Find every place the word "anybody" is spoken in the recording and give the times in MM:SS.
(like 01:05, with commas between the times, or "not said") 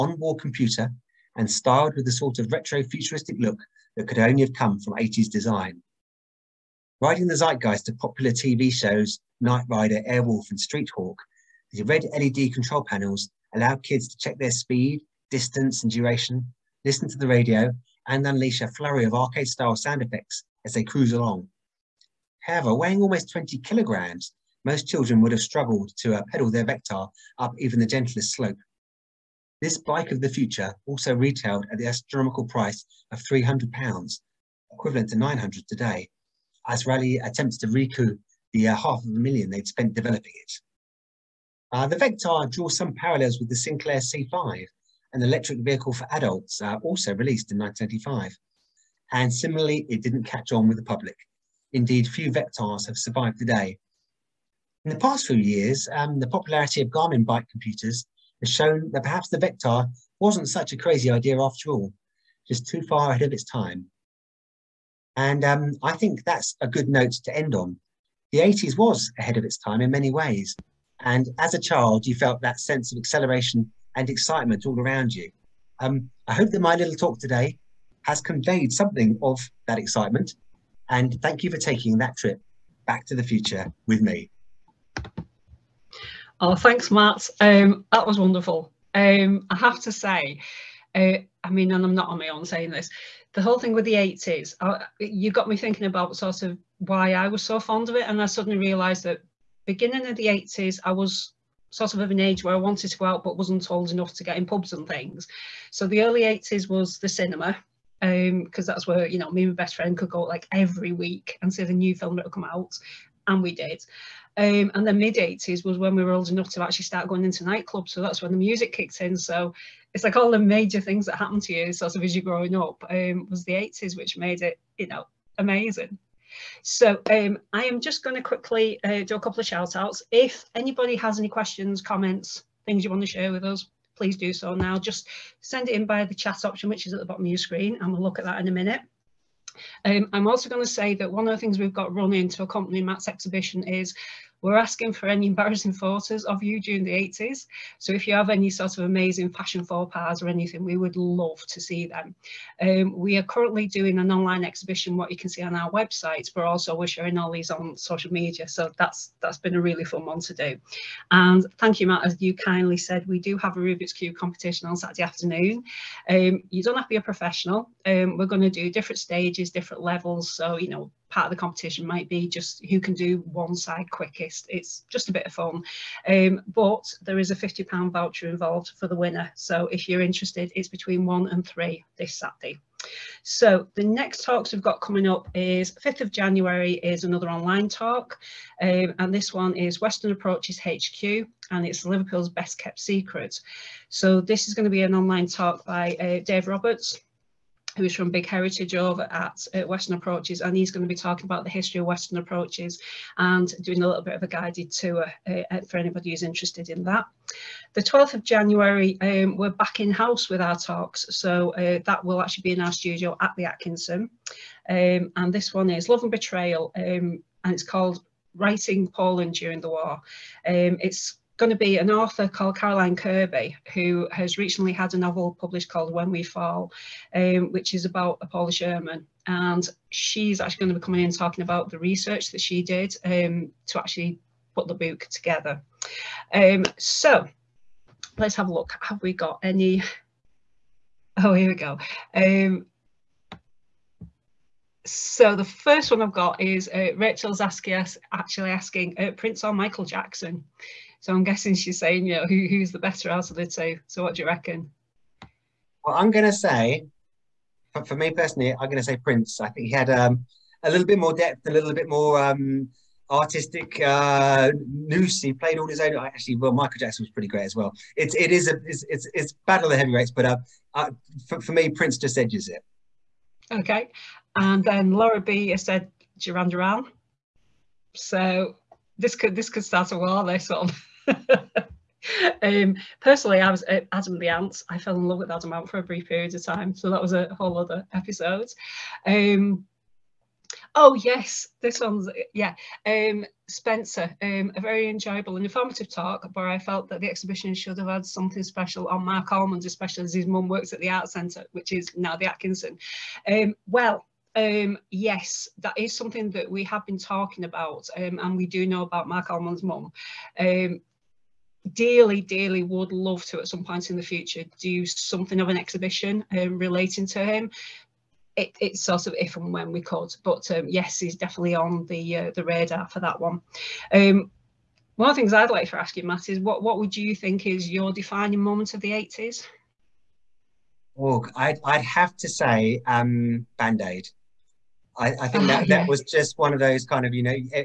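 02:10, 03:25.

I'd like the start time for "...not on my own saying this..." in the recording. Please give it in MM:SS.
01:31.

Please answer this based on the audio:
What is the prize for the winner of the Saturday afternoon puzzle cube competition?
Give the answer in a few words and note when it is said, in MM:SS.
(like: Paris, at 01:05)
£50 voucher, at 02:57.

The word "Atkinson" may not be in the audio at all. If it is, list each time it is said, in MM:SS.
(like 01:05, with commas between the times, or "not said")
03:33, 05:02.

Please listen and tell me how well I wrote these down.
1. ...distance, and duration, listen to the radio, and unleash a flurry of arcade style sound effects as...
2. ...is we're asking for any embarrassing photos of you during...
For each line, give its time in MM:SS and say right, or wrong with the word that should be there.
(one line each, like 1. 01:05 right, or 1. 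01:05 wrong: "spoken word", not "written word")
1. 00:15 right
2. 02:23 right.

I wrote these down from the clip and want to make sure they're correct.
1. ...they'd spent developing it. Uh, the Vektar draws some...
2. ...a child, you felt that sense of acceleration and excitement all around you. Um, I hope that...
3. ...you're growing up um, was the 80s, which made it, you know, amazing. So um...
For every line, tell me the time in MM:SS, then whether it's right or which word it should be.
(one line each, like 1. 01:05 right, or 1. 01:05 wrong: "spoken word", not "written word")
1. 00:39 right
2. 01:11 right
3. 02:02 right.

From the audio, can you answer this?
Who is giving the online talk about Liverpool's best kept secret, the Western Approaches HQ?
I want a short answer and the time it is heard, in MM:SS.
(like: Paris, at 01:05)
Dave Roberts, at 03:16.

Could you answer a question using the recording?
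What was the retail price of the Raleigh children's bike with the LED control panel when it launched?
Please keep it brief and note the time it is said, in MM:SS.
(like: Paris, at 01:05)
£300, at 00:33.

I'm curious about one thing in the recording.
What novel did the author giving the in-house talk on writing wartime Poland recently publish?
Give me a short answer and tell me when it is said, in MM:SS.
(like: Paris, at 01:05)
When We Fall, at 03:45.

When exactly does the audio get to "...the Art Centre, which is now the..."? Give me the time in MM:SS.
05:00.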